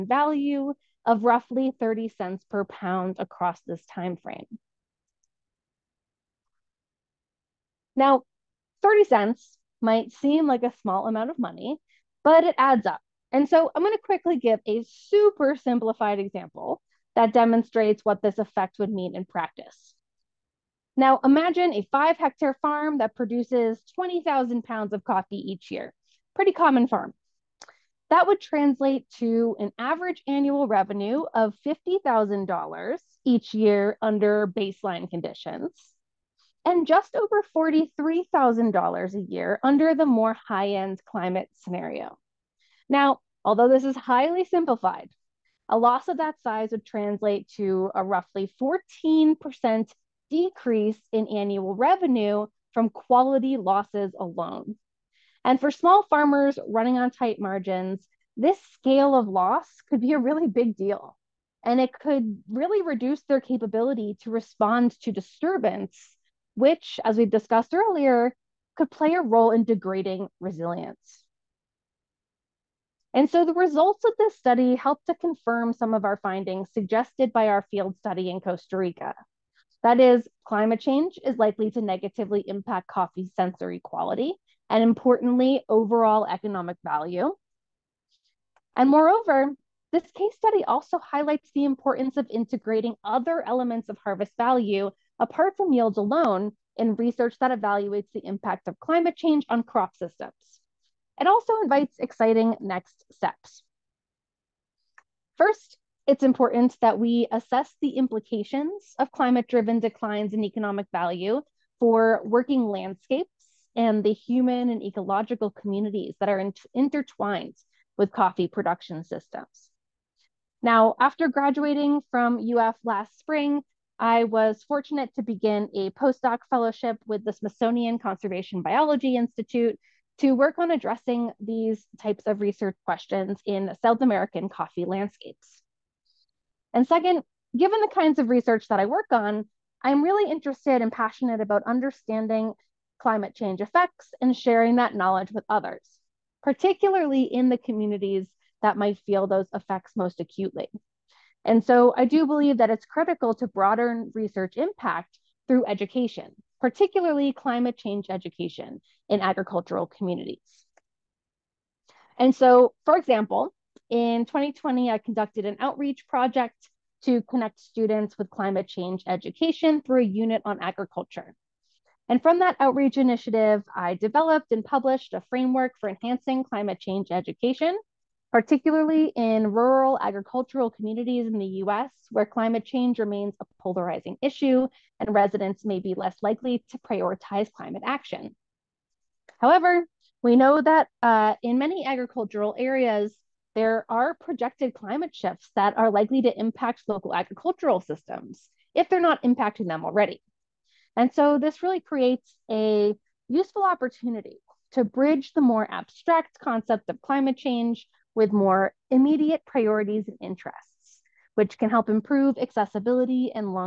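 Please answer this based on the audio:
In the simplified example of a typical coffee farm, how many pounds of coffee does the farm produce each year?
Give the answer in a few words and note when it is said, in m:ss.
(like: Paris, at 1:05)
20,000 pounds, at 0:23.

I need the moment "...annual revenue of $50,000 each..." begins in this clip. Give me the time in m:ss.
0:30.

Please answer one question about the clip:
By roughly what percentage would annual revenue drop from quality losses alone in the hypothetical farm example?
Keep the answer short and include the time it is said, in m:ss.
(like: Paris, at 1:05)
14%, at 0:48.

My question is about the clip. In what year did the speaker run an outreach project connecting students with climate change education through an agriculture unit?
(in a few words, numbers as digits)
2020.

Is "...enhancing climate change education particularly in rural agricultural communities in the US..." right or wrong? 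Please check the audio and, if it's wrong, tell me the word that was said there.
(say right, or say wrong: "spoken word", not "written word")
right.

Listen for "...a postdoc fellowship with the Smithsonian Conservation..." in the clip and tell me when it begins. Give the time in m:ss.
2:05.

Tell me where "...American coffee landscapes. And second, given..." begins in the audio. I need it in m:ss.
2:14.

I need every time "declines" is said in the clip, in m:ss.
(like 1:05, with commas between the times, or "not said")
1:49.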